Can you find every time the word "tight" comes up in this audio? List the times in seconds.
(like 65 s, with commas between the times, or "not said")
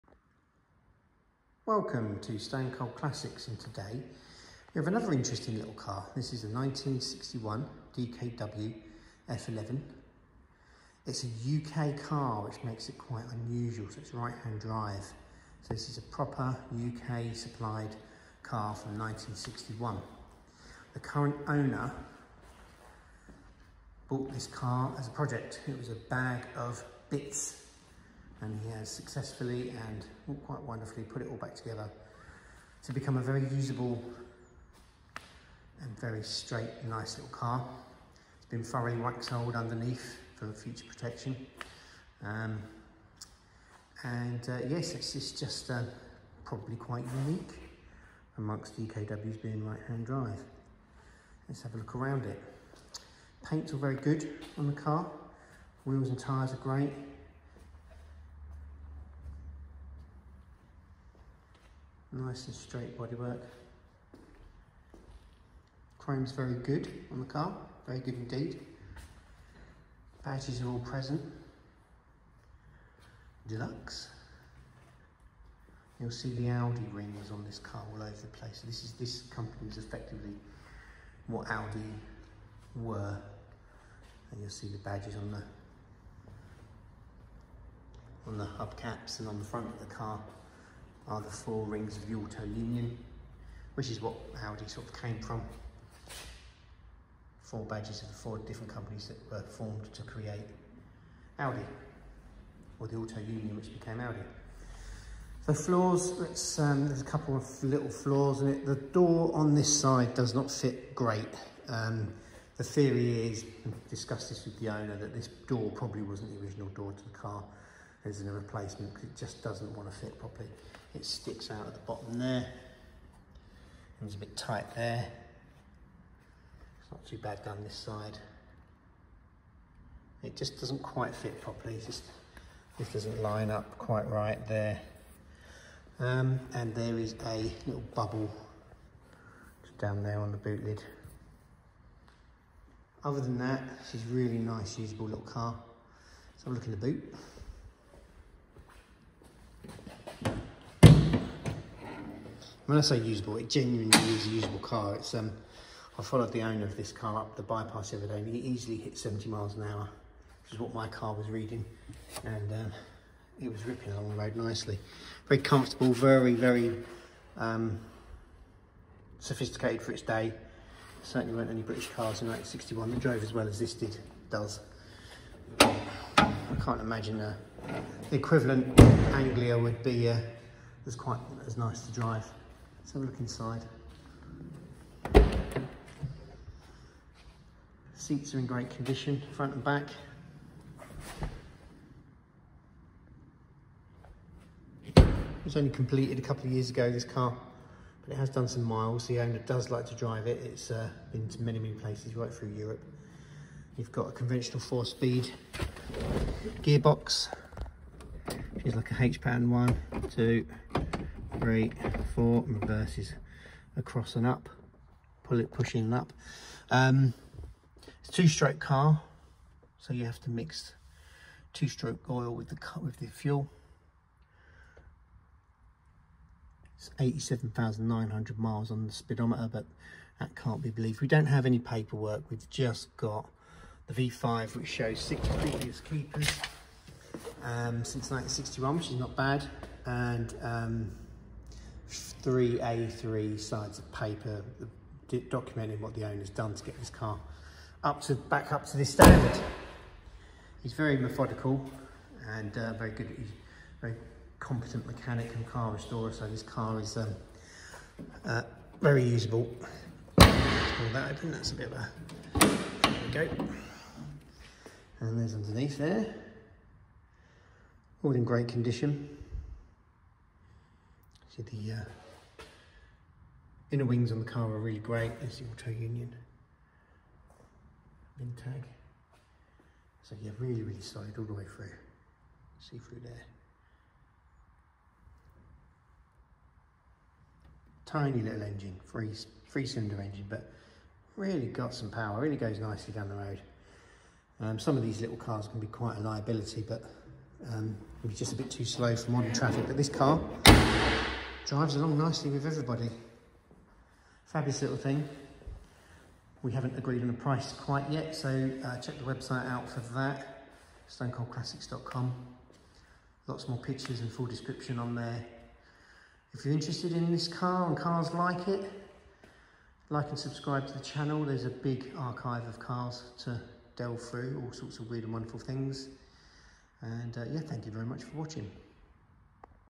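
124 s.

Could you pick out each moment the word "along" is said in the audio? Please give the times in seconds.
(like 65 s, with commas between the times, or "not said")
163 s, 301 s.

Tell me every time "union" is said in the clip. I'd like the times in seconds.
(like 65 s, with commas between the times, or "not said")
92 s, 103 s, 275 s.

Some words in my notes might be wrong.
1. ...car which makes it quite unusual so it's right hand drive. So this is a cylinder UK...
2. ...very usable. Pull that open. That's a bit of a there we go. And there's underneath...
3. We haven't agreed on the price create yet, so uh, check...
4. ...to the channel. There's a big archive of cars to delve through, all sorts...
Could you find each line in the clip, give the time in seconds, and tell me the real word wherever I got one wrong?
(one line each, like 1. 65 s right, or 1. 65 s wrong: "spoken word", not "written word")
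1. 11 s wrong: "proper", not "cylinder"
2. 258 s right
3. 306 s wrong: "quite", not "create"
4. 320 s right.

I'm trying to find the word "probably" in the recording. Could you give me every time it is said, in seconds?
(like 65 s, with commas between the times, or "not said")
46 s, 115 s.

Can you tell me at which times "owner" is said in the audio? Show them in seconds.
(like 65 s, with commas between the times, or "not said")
21 s, 114 s, 156 s, 199 s, 246 s.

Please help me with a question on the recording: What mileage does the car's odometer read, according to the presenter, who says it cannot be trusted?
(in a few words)
87,900 miles.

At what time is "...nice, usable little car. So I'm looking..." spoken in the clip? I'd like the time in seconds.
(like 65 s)
144 s.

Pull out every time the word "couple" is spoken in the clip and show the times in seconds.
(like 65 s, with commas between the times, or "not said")
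107 s, 196 s.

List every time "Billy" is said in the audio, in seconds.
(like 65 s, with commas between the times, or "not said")
not said.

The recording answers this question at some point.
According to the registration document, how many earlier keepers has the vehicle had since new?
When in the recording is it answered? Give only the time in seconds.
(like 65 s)
234 s.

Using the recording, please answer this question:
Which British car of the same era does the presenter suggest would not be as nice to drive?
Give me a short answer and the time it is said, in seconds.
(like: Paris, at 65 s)
Anglia, at 179 s.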